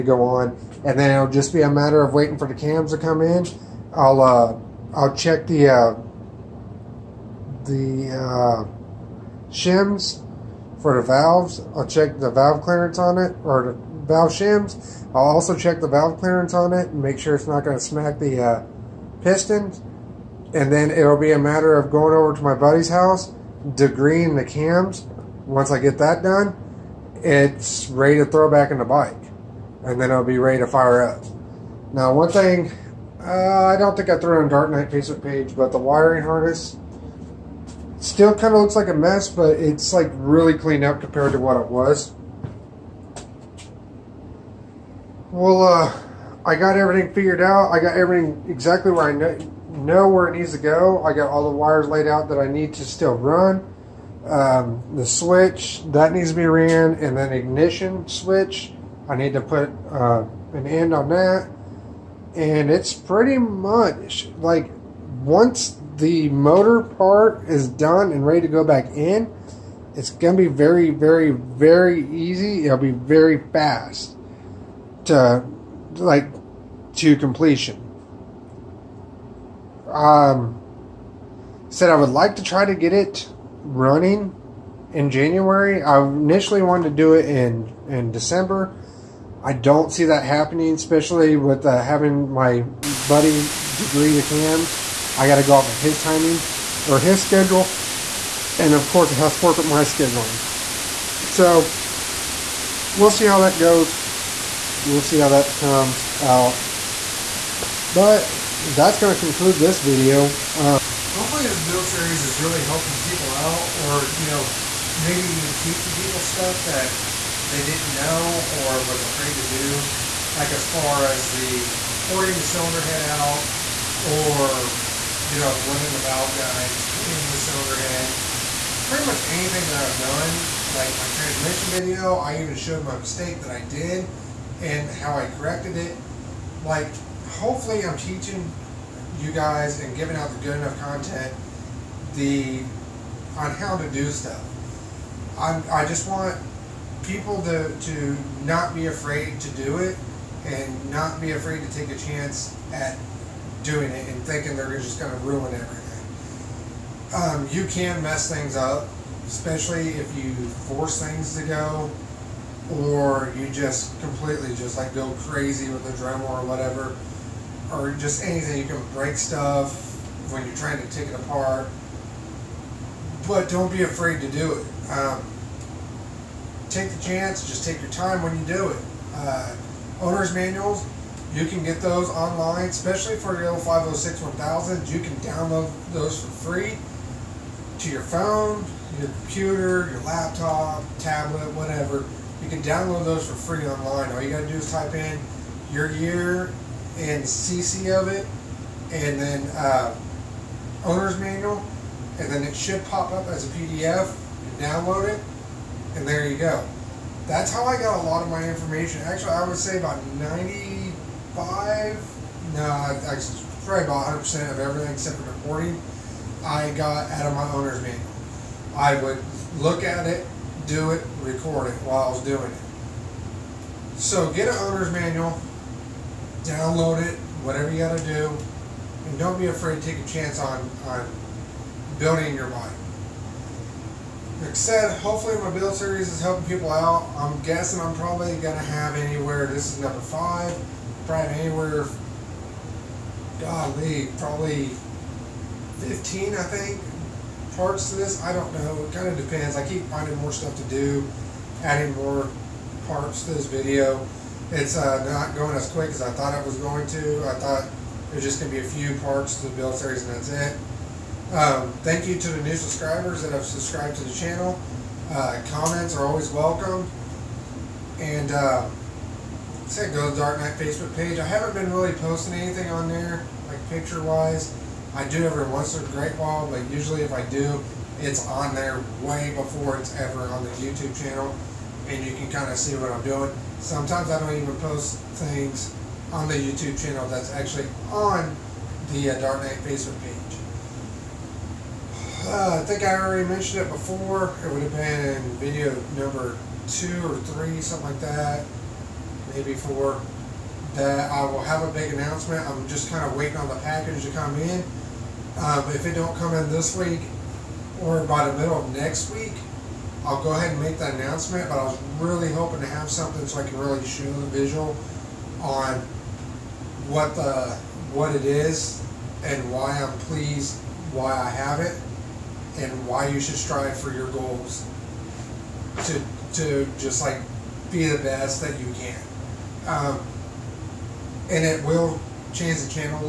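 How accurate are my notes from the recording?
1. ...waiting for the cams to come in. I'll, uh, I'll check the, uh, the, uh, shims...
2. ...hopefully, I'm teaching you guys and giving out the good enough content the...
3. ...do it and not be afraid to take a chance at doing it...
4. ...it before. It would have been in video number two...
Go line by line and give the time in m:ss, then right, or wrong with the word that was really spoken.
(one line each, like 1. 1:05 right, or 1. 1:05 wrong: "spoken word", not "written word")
1. 0:02 right
2. 2:17 right
3. 2:29 right
4. 4:53 right.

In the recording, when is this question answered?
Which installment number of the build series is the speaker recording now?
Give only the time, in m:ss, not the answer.
3:59.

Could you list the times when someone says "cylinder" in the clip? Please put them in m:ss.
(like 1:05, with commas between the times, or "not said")
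2:02, 2:07.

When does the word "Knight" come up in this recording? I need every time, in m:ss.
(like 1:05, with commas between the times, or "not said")
0:34, 4:30, 4:49.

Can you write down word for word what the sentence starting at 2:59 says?
Uh, owner's manuals, you can get those online, especially for your 506 1000.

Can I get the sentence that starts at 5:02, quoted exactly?
I'm just kind of waiting on the package to come in.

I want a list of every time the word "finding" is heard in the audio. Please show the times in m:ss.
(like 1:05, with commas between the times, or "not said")
4:09.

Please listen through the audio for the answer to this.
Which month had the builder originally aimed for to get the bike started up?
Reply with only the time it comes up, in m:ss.
1:28.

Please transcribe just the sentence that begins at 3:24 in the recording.
You download it, and there you go.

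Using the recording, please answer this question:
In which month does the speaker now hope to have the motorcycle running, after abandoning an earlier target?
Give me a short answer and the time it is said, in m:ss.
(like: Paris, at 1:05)
January, at 1:25.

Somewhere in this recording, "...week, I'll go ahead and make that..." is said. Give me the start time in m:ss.
5:09.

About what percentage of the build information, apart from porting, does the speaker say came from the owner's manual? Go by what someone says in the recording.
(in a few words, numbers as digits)
100%.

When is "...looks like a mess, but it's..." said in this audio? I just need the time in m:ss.
0:38.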